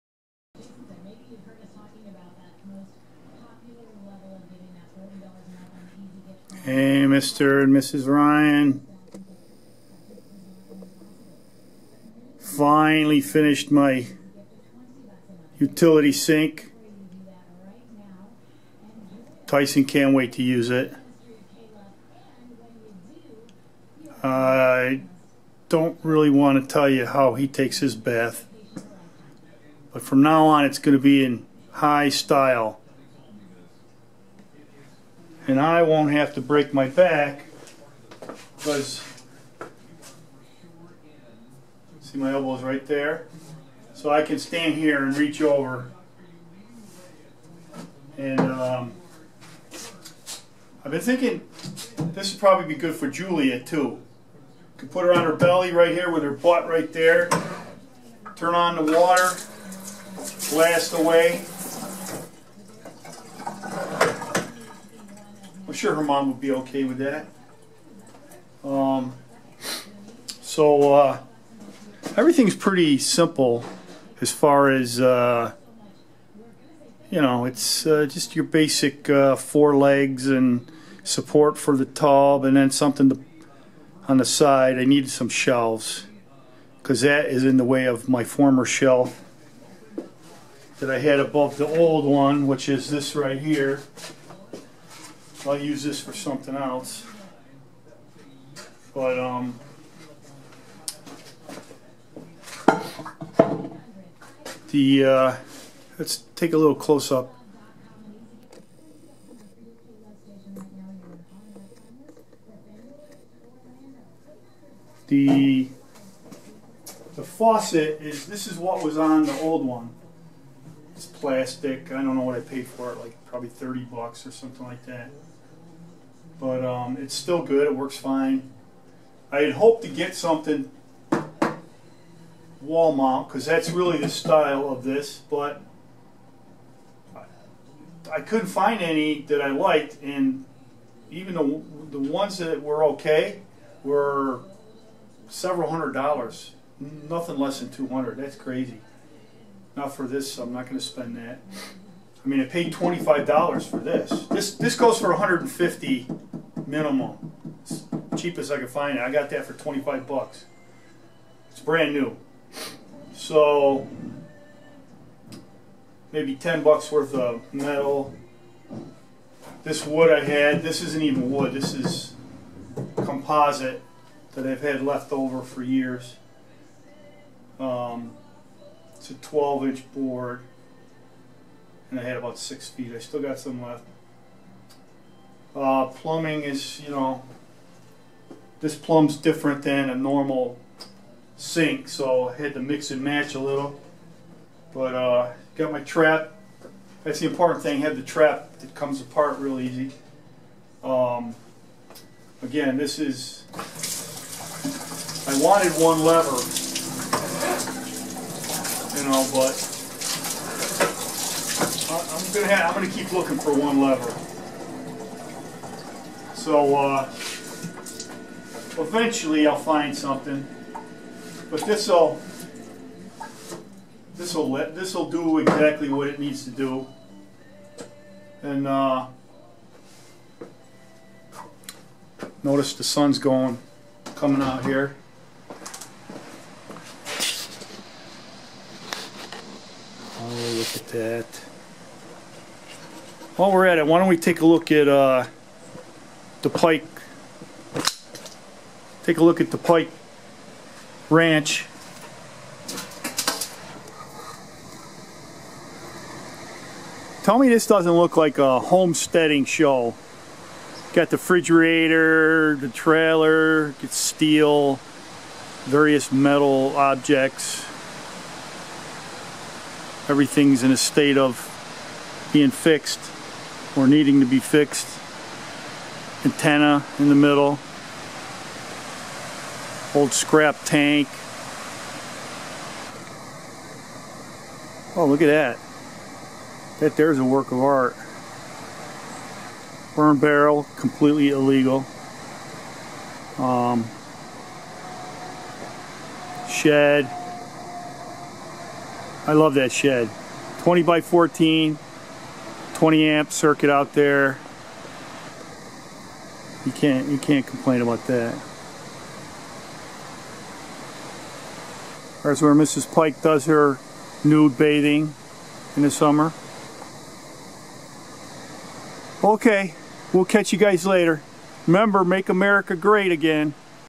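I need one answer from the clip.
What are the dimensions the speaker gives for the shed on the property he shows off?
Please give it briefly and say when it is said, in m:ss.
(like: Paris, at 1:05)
20 by 14, at 5:00.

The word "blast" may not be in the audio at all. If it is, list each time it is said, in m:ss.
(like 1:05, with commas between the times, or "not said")
1:00.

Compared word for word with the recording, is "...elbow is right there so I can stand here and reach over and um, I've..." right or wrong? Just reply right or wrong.
right.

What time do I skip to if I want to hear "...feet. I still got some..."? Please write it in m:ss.
3:02.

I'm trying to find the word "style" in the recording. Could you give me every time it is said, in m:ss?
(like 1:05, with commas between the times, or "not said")
0:32, 2:14.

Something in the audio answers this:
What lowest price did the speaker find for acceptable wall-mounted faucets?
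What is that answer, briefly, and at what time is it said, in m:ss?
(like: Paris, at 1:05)
200, at 2:27.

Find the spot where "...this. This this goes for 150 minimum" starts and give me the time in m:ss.
2:33.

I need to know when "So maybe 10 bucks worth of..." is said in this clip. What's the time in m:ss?
2:43.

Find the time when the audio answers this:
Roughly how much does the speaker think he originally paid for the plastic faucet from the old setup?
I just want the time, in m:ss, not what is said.
2:03.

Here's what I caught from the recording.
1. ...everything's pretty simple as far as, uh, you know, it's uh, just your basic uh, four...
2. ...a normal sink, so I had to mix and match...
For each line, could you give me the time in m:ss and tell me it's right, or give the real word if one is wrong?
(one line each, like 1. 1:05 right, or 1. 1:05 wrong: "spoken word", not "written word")
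1. 1:12 right
2. 3:09 right.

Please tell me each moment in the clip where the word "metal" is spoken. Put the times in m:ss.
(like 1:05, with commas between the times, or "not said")
2:47, 4:26.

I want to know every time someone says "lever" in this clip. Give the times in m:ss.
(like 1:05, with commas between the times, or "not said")
3:26, 3:33.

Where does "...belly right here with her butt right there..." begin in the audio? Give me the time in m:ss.
0:55.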